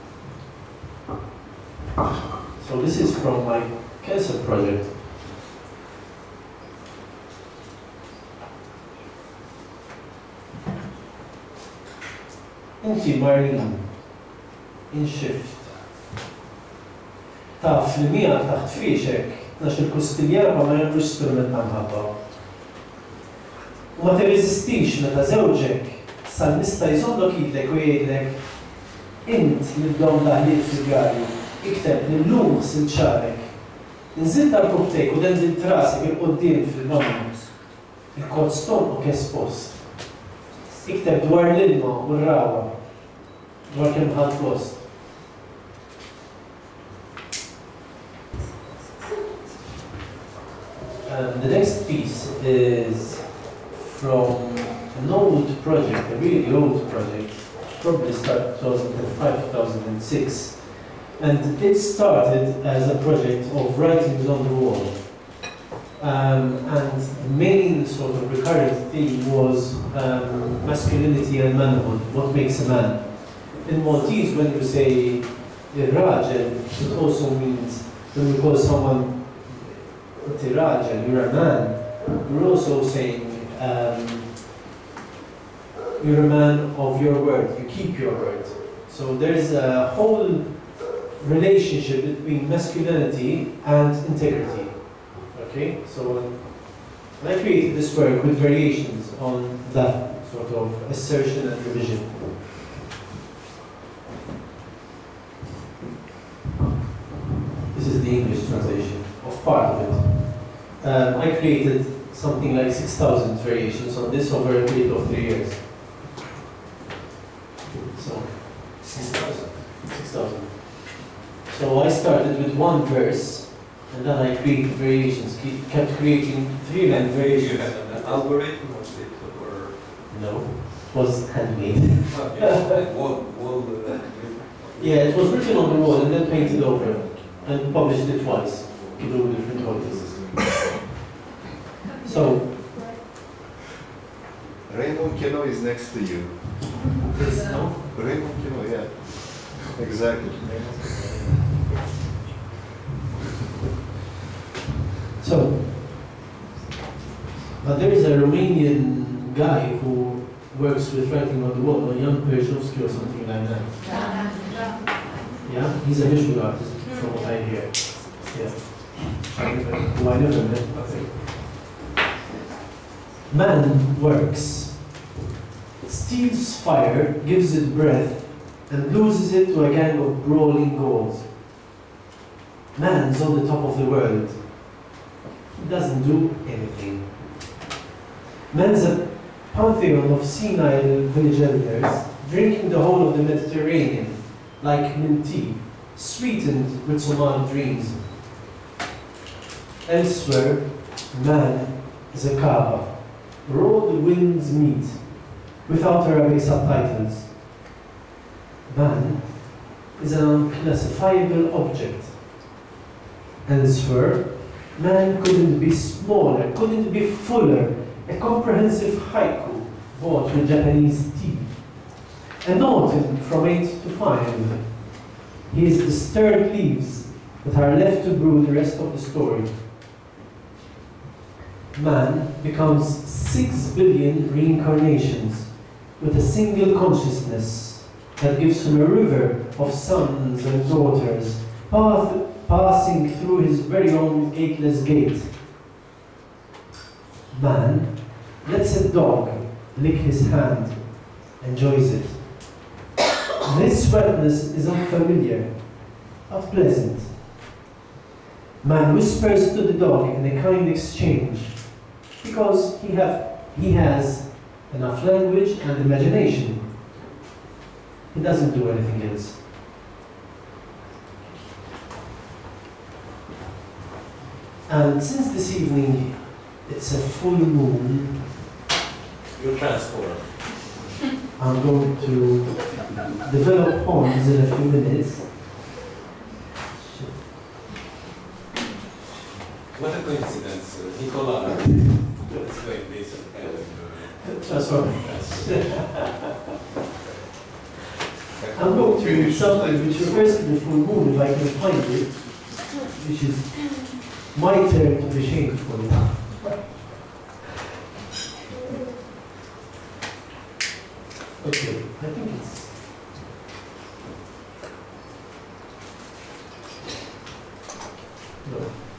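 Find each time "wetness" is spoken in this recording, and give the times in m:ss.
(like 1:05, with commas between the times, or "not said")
4:13.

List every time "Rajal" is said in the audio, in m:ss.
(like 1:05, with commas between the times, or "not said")
1:15, 1:20.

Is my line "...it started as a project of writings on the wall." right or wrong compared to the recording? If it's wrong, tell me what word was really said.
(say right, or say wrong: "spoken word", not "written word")
right.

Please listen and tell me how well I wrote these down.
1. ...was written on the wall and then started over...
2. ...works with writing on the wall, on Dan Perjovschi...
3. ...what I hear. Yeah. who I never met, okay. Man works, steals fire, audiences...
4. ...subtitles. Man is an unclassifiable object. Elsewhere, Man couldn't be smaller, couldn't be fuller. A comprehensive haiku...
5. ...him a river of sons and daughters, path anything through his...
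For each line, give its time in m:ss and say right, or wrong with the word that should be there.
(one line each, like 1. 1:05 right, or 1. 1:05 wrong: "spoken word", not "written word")
1. 2:15 wrong: "painted", not "started"
2. 2:40 right
3. 2:47 wrong: "gives", not "audiences"
4. 3:26 right
5. 3:58 wrong: "passing", not "anything".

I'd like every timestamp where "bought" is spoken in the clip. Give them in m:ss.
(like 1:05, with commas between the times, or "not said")
3:40.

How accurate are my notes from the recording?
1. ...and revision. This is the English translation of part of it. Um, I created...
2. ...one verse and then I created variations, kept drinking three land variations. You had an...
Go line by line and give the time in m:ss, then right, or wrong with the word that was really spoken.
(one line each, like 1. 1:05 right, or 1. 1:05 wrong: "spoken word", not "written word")
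1. 1:41 right
2. 2:02 wrong: "creating", not "drinking".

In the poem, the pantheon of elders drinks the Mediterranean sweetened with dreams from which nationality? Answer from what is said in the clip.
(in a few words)
Somali.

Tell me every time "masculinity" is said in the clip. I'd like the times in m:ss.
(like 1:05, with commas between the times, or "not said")
1:10, 1:32.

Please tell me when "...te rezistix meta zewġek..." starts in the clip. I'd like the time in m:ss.
0:24.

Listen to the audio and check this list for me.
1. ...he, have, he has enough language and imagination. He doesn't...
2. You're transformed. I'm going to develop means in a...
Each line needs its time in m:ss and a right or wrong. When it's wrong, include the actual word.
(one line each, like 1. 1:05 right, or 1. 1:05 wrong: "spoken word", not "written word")
1. 4:22 right
2. 4:39 wrong: "horns", not "means".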